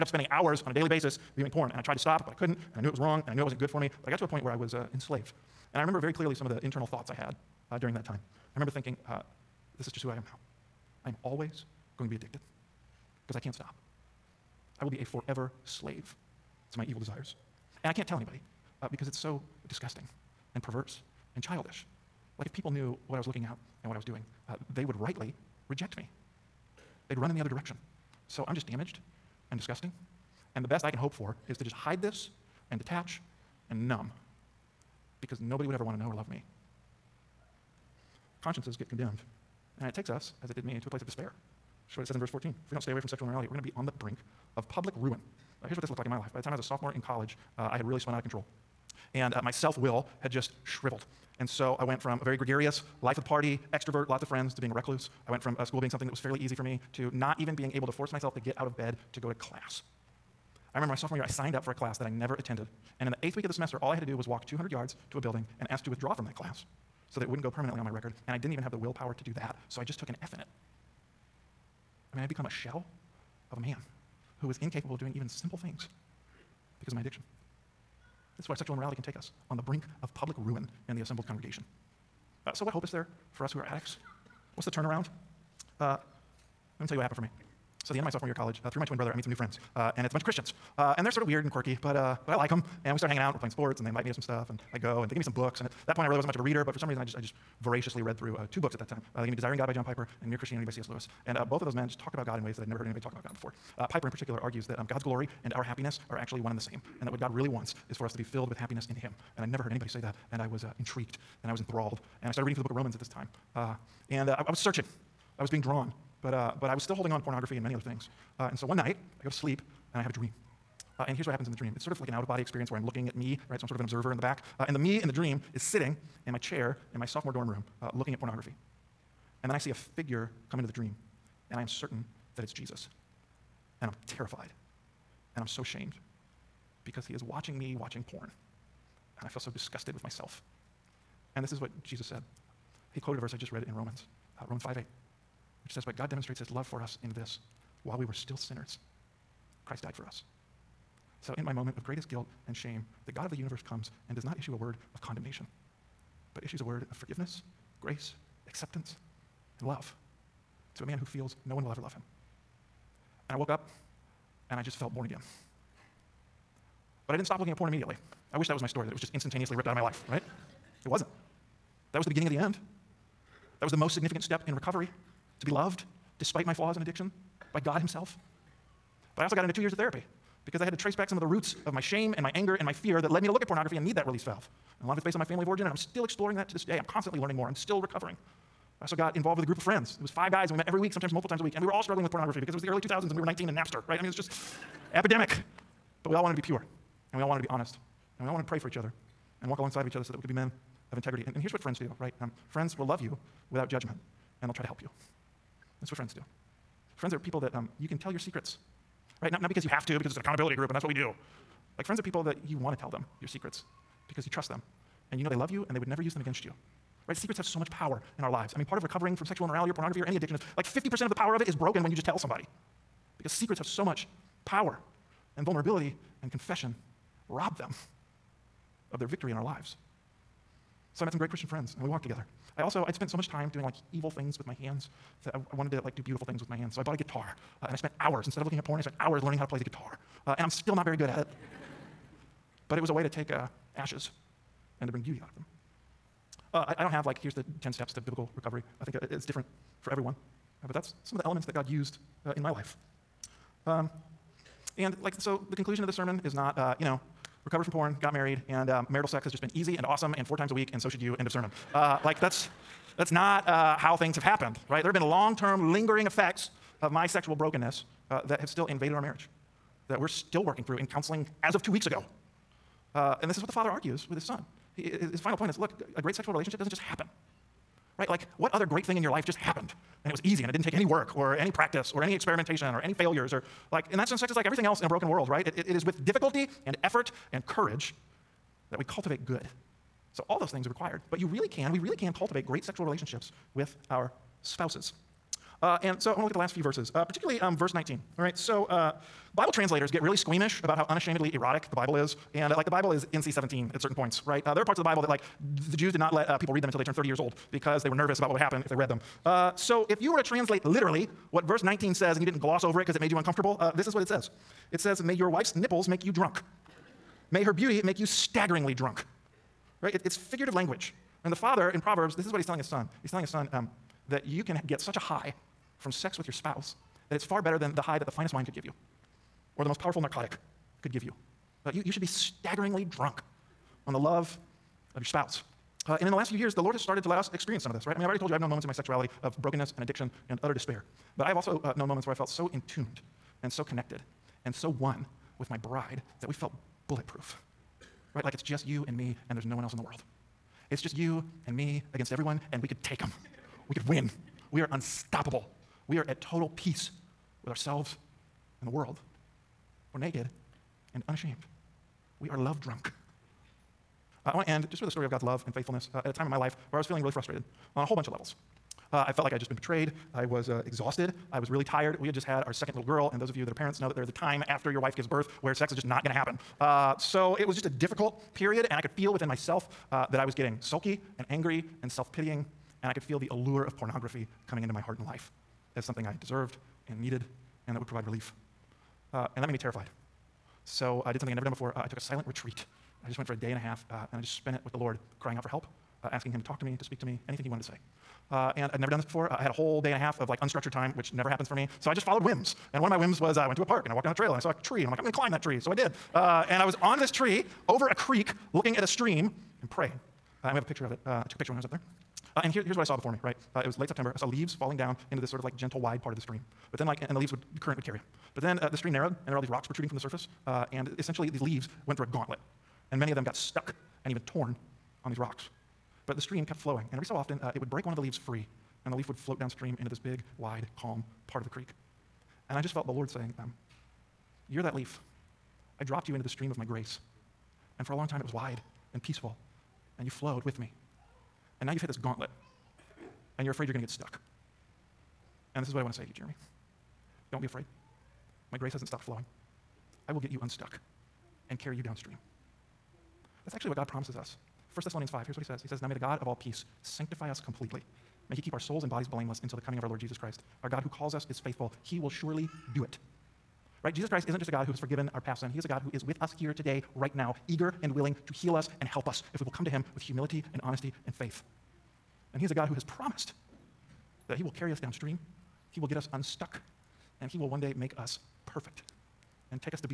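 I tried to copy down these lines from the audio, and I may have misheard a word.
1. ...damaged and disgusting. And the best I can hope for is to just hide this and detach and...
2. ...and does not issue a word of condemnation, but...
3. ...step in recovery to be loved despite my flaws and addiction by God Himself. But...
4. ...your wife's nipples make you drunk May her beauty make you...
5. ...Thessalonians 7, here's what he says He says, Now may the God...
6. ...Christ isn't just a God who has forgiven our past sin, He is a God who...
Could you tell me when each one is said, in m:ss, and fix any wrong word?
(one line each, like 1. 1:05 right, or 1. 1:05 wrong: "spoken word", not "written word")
1. 0:28 right
2. 2:34 right
3. 2:54 right
4. 5:15 right
5. 7:34 wrong: "5", not "7"
6. 7:44 right.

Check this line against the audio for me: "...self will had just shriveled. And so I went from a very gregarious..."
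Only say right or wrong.
right.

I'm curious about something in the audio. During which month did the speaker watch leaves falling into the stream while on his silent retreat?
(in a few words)
September.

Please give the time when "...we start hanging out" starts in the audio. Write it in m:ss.
1:32.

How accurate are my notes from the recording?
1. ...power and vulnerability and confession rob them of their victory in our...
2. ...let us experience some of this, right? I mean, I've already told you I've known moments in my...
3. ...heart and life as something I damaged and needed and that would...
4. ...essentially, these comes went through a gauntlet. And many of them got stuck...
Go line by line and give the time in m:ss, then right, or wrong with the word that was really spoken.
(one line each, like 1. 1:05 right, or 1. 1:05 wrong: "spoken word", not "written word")
1. 3:44 right
2. 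5:37 right
3. 6:24 wrong: "deserved", not "damaged"
4. 7:00 wrong: "leaves", not "comes".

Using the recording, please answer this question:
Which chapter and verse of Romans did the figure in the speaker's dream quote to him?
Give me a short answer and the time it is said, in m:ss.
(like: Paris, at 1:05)
Romans 5:8, at 2:24.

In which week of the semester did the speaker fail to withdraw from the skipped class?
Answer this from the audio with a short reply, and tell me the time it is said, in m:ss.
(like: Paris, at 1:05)
8th week, at 1:03.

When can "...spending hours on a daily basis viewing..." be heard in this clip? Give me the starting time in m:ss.
0:00.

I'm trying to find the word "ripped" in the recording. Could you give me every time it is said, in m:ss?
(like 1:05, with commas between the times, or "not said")
2:49.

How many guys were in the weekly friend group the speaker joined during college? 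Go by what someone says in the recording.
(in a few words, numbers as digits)
5.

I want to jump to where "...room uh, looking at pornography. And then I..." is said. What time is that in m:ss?
2:07.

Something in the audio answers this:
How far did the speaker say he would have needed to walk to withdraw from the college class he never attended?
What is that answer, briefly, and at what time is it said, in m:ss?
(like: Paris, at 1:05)
200 yards, at 1:04.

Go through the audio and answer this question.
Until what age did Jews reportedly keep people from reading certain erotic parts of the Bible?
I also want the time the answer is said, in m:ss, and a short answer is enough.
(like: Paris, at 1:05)
30, at 5:06.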